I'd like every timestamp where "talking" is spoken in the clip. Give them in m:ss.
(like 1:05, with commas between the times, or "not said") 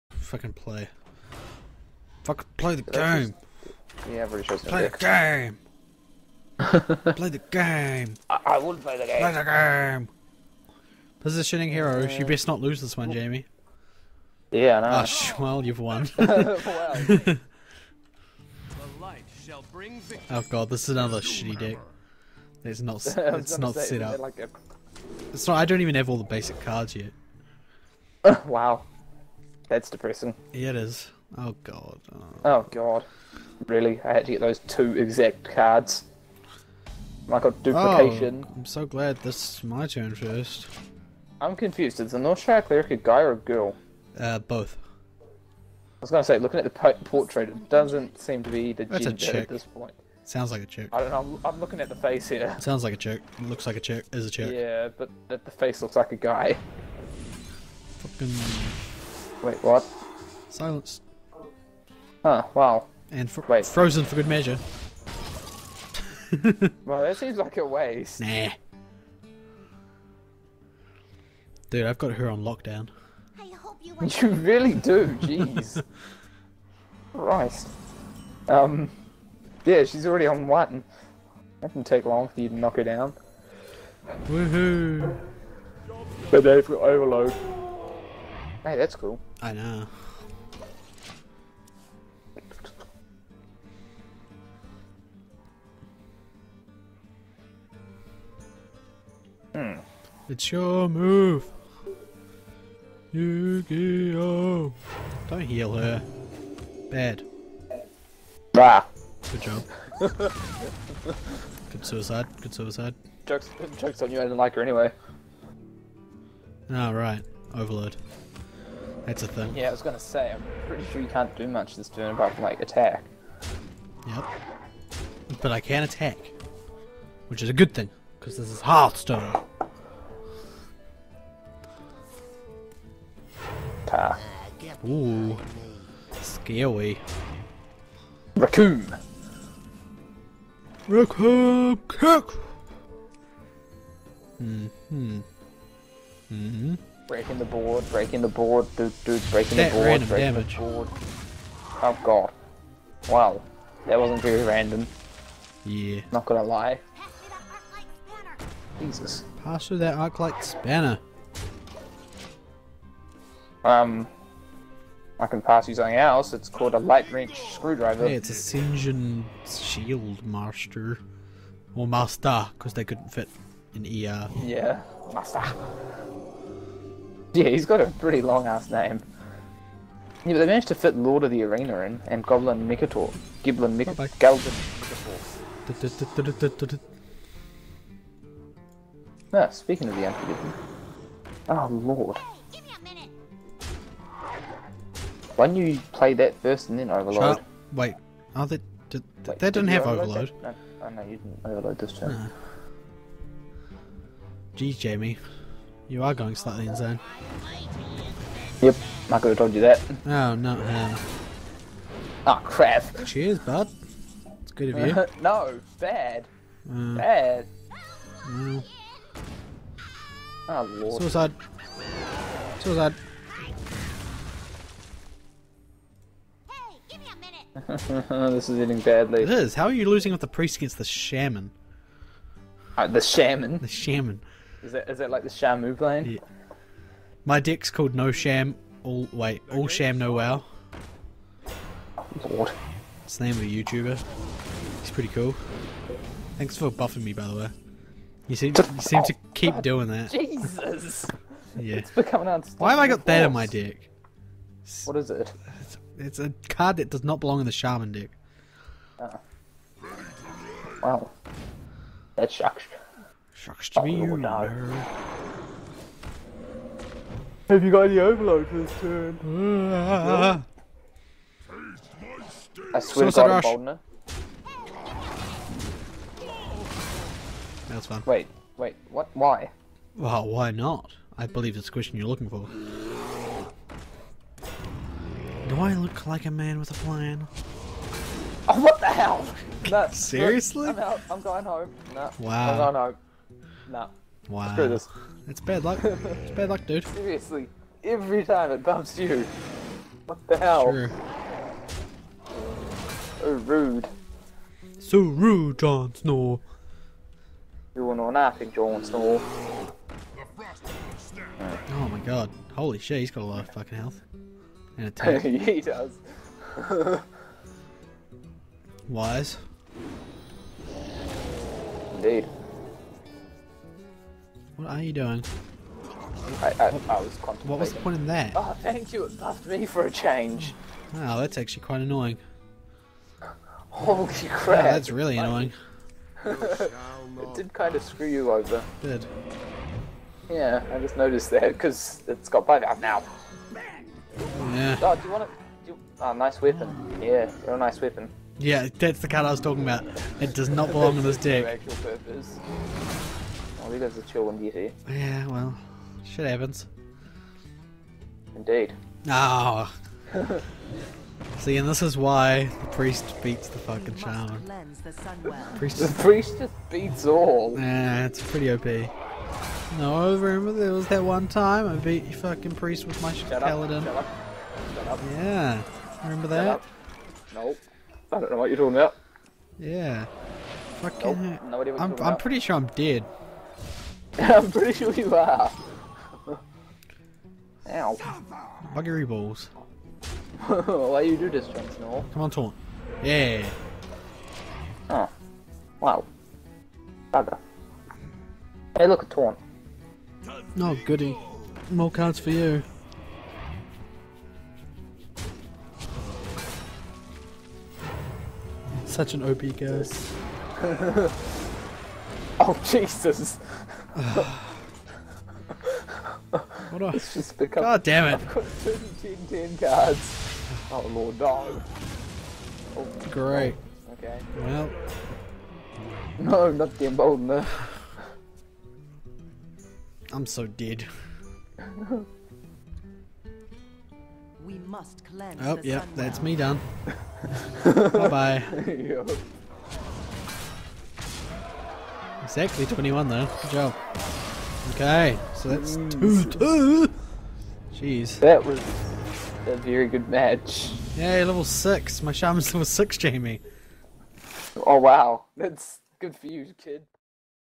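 5:49, 6:18.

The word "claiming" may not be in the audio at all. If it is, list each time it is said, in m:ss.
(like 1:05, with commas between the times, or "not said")
not said.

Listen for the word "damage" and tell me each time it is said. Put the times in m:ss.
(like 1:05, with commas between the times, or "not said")
2:30.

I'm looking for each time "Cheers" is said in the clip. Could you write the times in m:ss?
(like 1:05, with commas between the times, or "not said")
3:33.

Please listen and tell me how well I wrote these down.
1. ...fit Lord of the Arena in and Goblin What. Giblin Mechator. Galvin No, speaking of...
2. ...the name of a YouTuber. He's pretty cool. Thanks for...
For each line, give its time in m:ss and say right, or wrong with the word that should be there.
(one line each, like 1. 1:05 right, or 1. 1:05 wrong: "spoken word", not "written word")
1. 3:00 wrong: "Mechator", not "What"
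2. 4:03 right.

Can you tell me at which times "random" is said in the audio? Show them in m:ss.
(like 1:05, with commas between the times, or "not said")
2:29, 2:34.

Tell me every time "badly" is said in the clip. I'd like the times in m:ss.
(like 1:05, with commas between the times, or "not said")
3:48.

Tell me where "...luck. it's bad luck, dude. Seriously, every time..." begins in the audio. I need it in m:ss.
4:55.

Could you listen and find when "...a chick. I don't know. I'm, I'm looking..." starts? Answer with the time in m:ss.
0:50.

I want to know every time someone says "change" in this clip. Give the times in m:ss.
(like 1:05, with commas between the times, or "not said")
5:29.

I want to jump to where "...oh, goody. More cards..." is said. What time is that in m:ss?
6:40.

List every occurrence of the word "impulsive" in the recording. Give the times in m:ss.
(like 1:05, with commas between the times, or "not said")
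not said.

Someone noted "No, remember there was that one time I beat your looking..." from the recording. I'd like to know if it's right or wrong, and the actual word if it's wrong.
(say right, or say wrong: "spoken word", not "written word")
wrong: "fucking", not "looking".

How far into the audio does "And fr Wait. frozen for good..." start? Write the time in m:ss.
1:03.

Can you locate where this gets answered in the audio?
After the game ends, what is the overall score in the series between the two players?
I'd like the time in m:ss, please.
7:25.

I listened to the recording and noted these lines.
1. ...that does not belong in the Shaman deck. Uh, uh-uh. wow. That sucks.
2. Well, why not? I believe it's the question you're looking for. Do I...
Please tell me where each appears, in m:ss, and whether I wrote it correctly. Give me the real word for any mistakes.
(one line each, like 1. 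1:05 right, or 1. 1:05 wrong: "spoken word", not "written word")
1. 4:16 right
2. 4:39 right.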